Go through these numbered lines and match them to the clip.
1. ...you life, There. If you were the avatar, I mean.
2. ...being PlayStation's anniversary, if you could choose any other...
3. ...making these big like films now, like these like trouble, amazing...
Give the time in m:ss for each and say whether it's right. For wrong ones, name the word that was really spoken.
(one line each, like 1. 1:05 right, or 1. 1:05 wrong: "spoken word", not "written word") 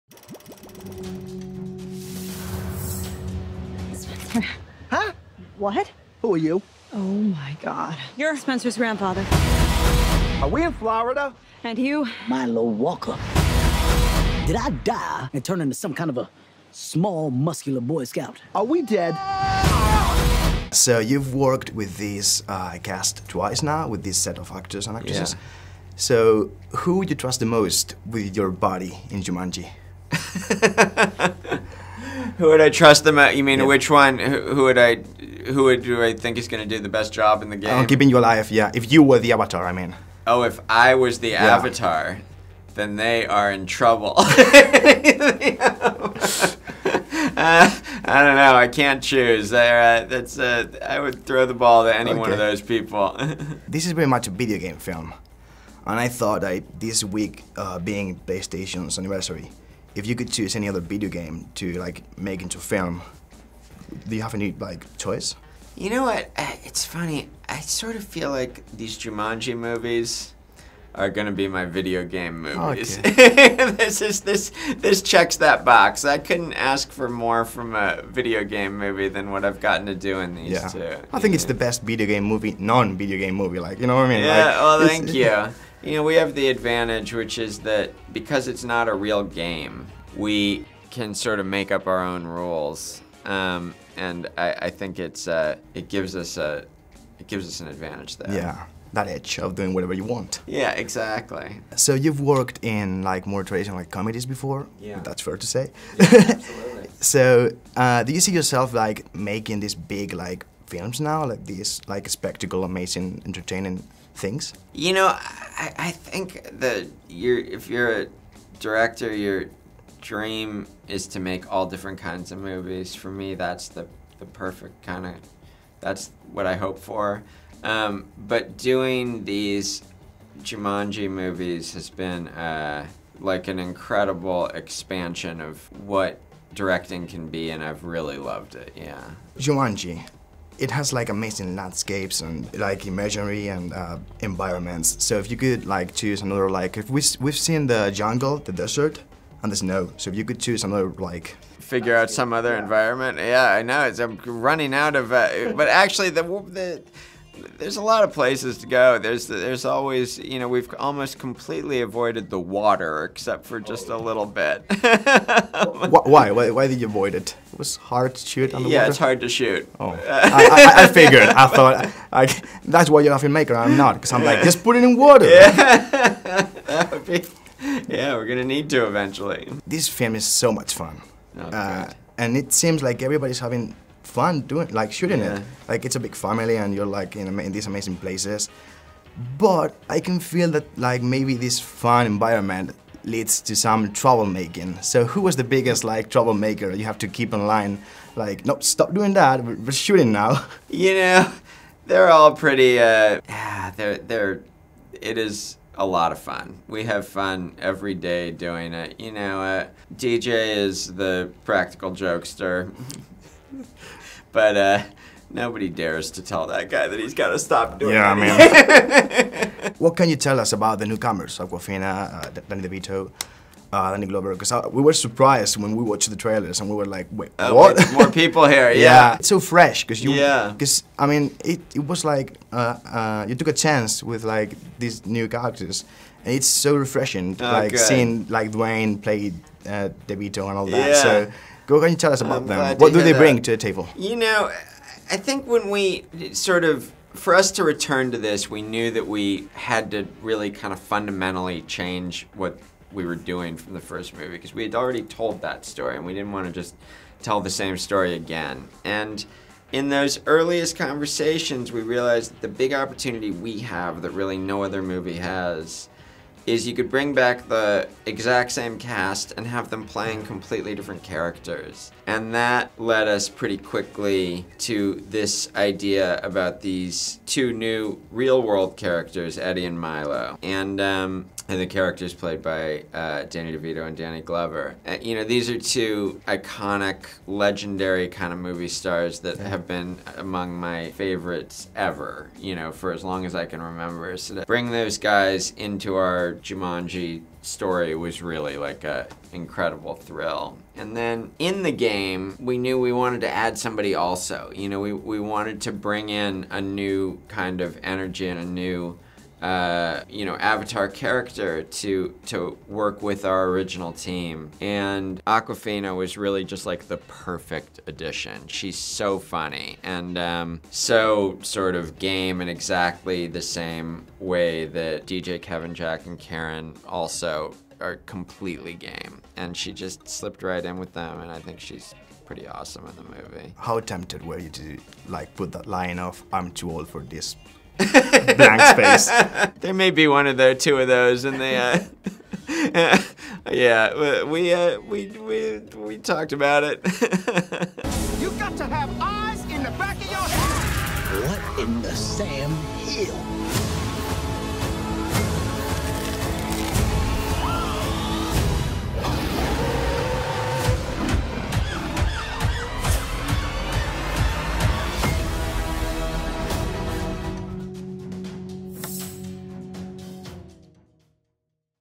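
1. 0:38 wrong: "Yeah", not "There"
2. 0:57 right
3. 1:49 wrong: "spectacle", not "trouble".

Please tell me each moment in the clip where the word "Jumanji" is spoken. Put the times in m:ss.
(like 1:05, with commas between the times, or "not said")
0:29, 1:08, 2:10, 2:19, 4:56.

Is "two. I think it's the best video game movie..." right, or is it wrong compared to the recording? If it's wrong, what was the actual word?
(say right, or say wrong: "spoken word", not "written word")
right.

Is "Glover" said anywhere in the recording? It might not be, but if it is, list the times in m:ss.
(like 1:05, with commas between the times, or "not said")
3:44, 4:44.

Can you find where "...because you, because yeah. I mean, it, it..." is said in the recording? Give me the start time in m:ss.
3:49.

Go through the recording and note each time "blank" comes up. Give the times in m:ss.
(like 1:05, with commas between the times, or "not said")
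5:38.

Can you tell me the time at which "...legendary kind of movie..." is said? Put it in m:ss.
4:47.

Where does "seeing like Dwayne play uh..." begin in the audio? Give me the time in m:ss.
3:57.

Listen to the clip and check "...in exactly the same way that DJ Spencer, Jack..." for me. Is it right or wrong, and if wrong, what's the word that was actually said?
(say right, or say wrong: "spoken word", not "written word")
wrong: "Kevin", not "Spencer".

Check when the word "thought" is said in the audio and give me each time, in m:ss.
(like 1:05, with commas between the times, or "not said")
0:56, 2:51.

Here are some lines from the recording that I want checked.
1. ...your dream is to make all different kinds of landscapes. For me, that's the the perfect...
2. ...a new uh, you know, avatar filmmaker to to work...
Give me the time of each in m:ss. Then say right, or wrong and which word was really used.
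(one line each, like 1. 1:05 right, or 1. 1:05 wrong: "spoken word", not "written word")
1. 1:59 wrong: "movies", not "landscapes"
2. 5:08 wrong: "character", not "filmmaker".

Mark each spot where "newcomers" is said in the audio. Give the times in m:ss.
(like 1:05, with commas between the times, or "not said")
3:40.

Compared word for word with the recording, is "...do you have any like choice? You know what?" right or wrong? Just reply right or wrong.
right.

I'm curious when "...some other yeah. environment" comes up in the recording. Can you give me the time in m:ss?
2:32.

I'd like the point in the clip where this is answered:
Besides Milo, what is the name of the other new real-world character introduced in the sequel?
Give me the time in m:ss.
4:39.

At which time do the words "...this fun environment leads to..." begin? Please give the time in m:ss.
3:11.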